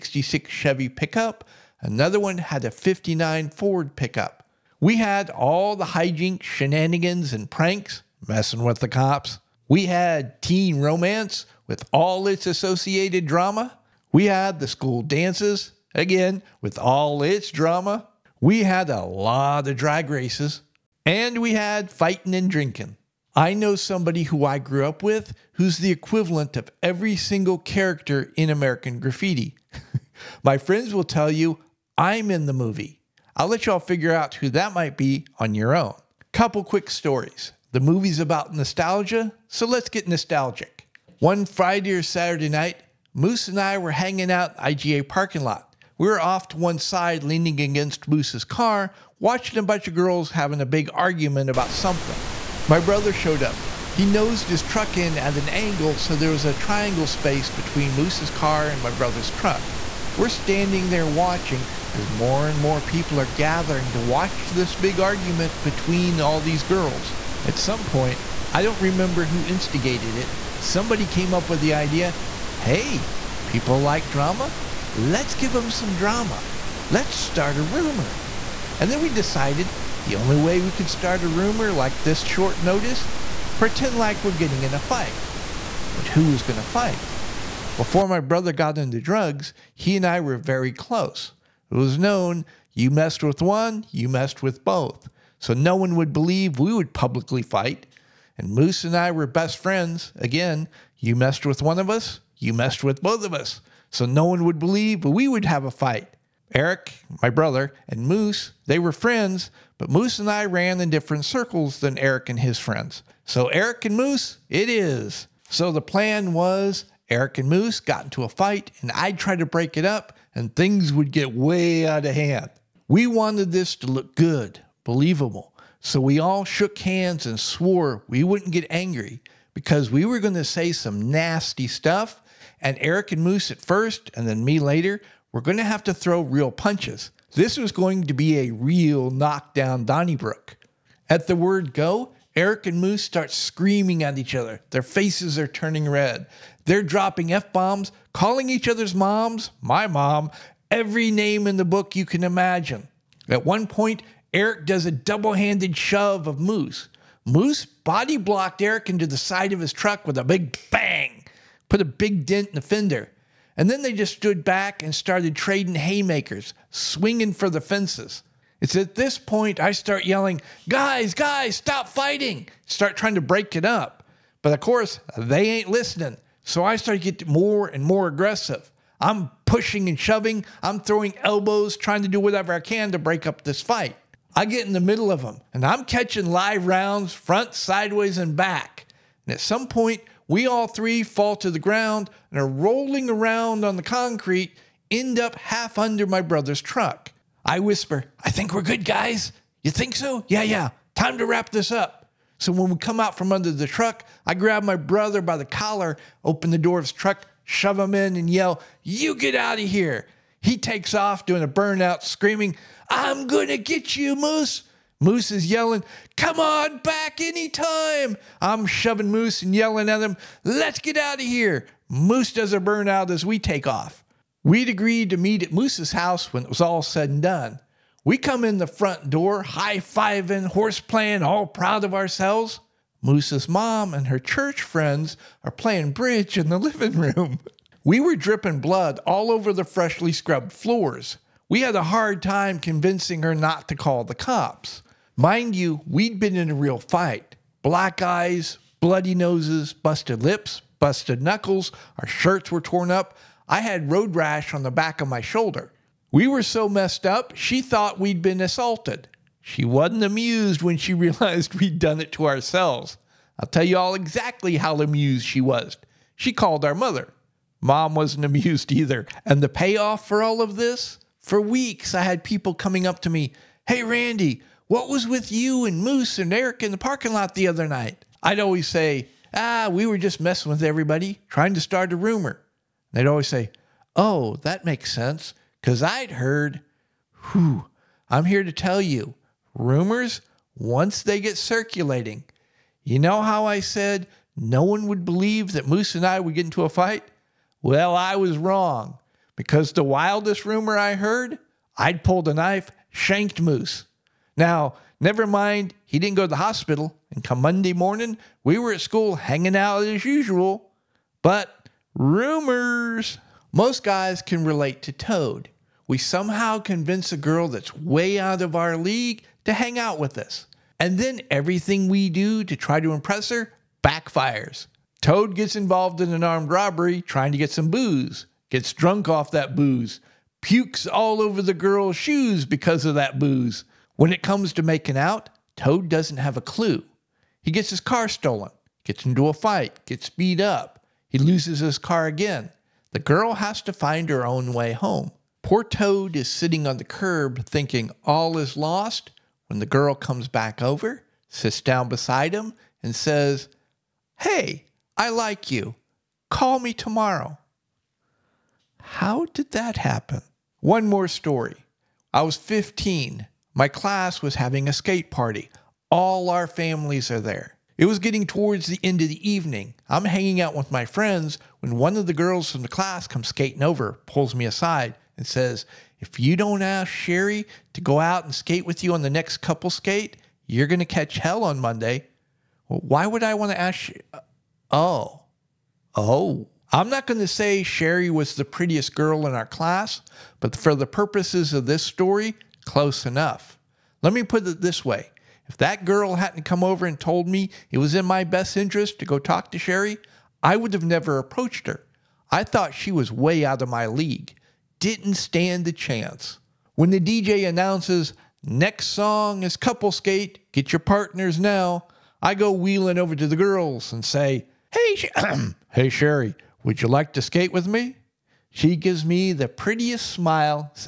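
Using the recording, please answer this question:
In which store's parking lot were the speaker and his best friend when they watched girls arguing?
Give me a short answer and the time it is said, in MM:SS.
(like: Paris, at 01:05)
IGA, at 00:44.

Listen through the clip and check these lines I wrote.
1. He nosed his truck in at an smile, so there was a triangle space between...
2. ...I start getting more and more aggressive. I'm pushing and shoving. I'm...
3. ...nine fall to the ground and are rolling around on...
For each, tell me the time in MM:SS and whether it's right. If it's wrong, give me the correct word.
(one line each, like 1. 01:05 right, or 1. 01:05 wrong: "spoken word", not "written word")
1. 00:53 wrong: "angle", not "smile"
2. 02:56 right
3. 03:10 wrong: "three", not "nine".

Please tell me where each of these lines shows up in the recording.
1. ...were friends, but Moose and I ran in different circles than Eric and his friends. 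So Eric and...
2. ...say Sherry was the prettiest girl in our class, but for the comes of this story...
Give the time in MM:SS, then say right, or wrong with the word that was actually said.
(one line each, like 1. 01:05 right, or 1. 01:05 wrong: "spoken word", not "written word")
1. 01:48 right
2. 06:27 wrong: "purposes", not "comes".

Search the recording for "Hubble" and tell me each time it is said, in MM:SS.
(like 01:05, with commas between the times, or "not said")
not said.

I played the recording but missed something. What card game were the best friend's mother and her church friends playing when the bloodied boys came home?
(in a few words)
Bridge.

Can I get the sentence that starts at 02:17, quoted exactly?
This was going to be a real knockdown Donnybrook.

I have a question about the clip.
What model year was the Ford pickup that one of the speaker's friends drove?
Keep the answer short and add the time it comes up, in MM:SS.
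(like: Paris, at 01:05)
59, at 00:02.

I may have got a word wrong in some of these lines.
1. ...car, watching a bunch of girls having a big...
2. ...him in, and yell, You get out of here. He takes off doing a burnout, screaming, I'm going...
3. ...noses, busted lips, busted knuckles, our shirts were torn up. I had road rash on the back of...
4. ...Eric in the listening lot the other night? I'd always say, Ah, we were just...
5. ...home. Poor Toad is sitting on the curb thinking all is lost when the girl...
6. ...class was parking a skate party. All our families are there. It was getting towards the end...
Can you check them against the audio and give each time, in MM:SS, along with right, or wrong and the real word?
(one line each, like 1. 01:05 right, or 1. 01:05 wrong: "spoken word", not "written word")
1. 00:48 right
2. 03:27 right
3. 04:09 right
4. 04:36 wrong: "parking", not "listening"
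5. 05:44 right
6. 06:03 wrong: "having", not "parking".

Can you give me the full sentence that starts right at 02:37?
Moose body blocked Eric into the side of his truck with a big bang put a big dent in the fender.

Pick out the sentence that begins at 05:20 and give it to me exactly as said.
And then everything we do to try to impress her backfires.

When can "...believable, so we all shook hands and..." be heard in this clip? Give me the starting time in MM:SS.
02:04.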